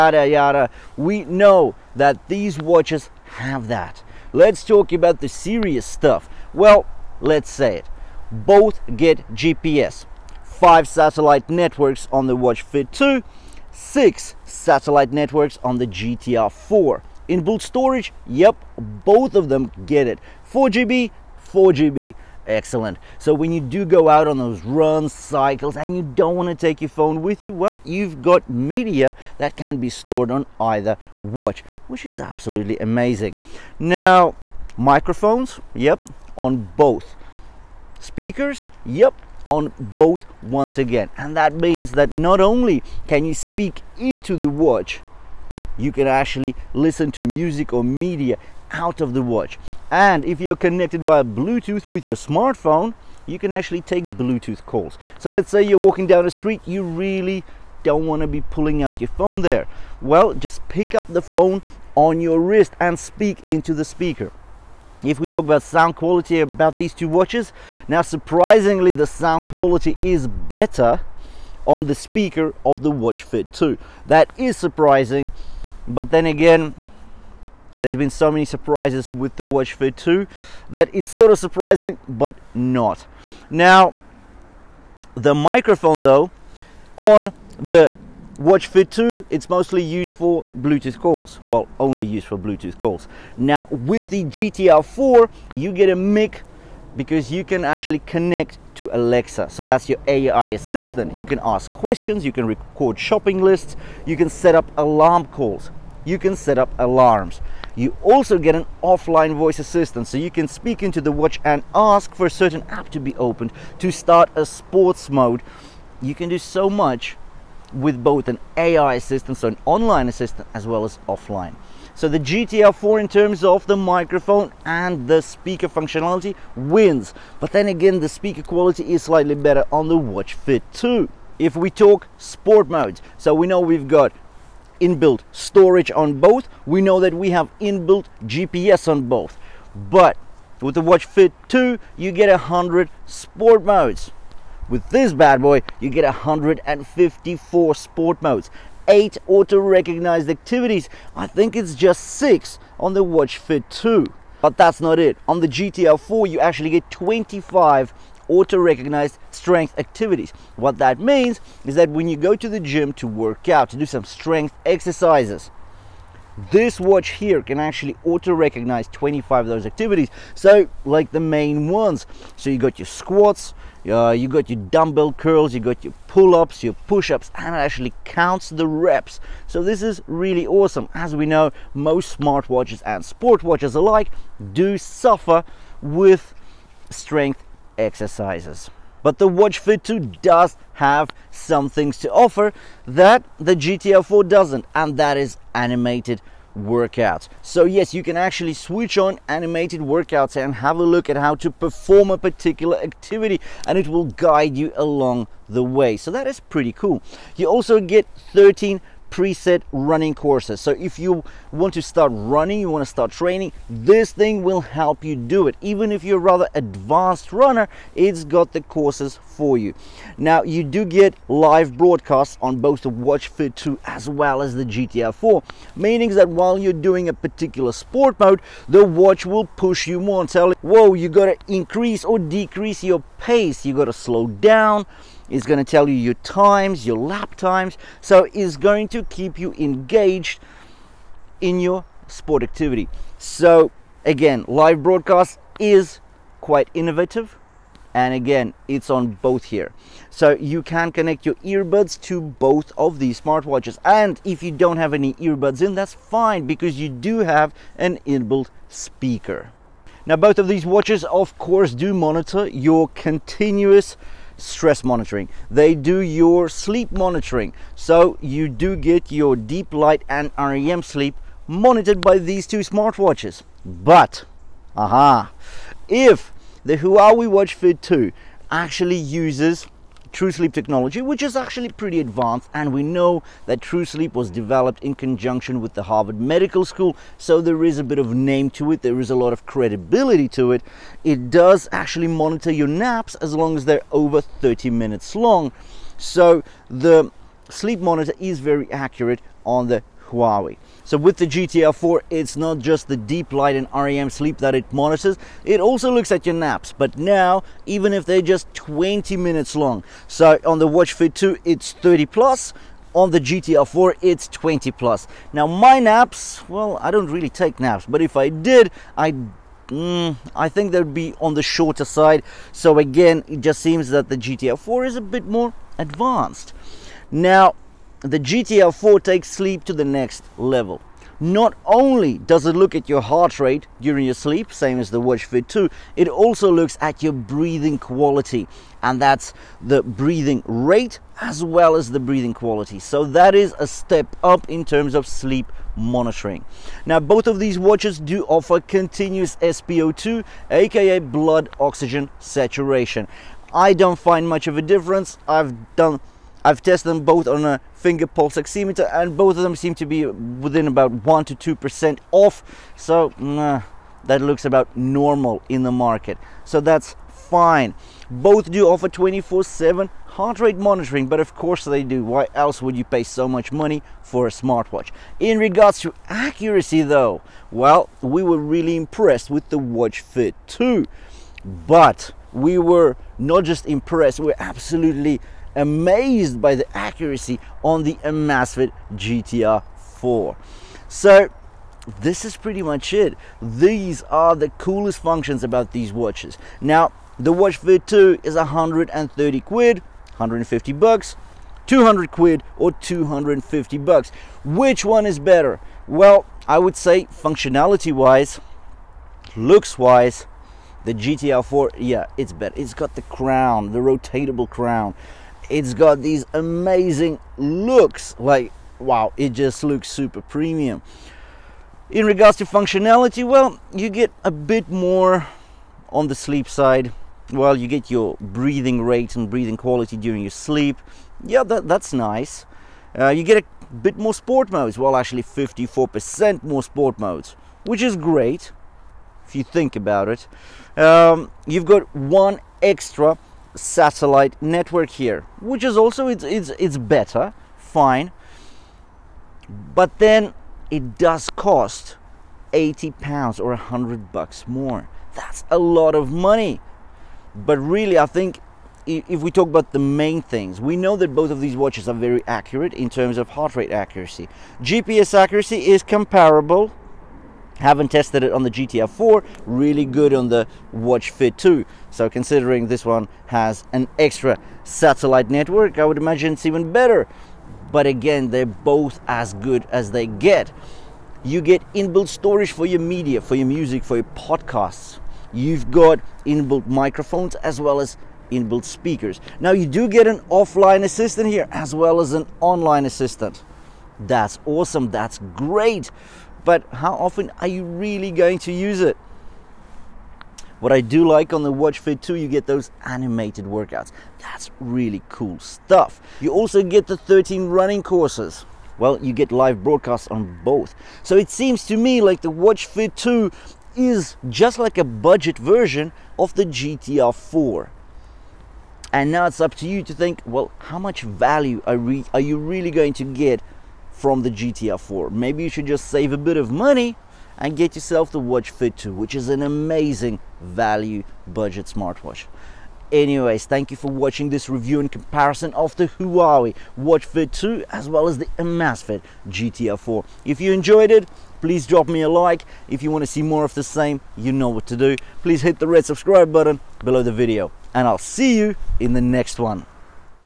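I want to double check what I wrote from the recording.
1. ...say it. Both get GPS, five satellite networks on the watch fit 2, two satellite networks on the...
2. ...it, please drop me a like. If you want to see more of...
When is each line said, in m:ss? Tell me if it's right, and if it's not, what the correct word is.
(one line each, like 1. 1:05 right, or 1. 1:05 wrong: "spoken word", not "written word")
1. 0:07 wrong: "six", not "two"
2. 9:00 right.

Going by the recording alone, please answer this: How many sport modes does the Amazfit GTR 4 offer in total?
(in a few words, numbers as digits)
154.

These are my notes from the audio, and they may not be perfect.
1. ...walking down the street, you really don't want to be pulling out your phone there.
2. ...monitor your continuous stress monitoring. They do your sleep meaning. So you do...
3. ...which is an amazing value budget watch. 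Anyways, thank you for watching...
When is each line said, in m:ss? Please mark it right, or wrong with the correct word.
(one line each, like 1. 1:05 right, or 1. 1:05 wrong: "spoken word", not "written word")
1. 0:55 right
2. 4:21 wrong: "monitoring", not "meaning"
3. 8:48 wrong: "smartwatch", not "watch".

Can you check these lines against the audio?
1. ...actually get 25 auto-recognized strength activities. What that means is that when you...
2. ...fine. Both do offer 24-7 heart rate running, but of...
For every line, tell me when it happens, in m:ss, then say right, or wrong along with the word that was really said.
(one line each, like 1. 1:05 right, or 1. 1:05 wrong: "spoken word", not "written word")
1. 2:36 right
2. 6:07 wrong: "monitoring", not "running".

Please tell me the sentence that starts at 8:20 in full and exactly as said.
What I do like on the Watch Fit 2, you get those animated workouts.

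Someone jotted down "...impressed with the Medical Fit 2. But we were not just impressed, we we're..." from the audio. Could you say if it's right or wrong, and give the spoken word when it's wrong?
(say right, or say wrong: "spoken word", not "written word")
wrong: "Watch", not "Medical".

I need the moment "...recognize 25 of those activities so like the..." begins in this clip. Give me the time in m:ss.
2:48.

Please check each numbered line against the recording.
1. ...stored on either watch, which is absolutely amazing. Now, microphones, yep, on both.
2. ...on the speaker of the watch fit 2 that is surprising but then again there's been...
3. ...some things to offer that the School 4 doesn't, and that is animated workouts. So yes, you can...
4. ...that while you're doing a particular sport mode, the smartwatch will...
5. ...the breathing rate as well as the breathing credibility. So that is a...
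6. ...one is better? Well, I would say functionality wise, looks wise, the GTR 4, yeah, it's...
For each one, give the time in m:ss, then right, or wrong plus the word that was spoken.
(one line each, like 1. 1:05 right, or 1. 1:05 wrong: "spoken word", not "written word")
1. 0:29 right
2. 1:11 right
3. 3:11 wrong: "GTR", not "School"
4. 3:46 wrong: "watch", not "smartwatch"
5. 5:39 wrong: "quality", not "credibility"
6. 6:44 right.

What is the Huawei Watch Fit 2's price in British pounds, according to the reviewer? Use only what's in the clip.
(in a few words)
130 pounds.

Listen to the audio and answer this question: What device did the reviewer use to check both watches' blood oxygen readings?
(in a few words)
finger pulse oximeter.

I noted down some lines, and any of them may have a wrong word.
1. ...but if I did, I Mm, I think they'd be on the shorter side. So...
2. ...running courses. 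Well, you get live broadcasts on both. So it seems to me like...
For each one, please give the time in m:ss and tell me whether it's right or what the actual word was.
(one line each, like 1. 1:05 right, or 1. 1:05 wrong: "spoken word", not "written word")
1. 5:17 right
2. 8:27 right.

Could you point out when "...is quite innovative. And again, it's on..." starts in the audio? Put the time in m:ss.
4:05.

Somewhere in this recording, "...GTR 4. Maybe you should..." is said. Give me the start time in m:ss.
8:44.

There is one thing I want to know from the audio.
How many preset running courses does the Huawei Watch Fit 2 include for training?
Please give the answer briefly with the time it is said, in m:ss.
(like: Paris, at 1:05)
13, at 3:28.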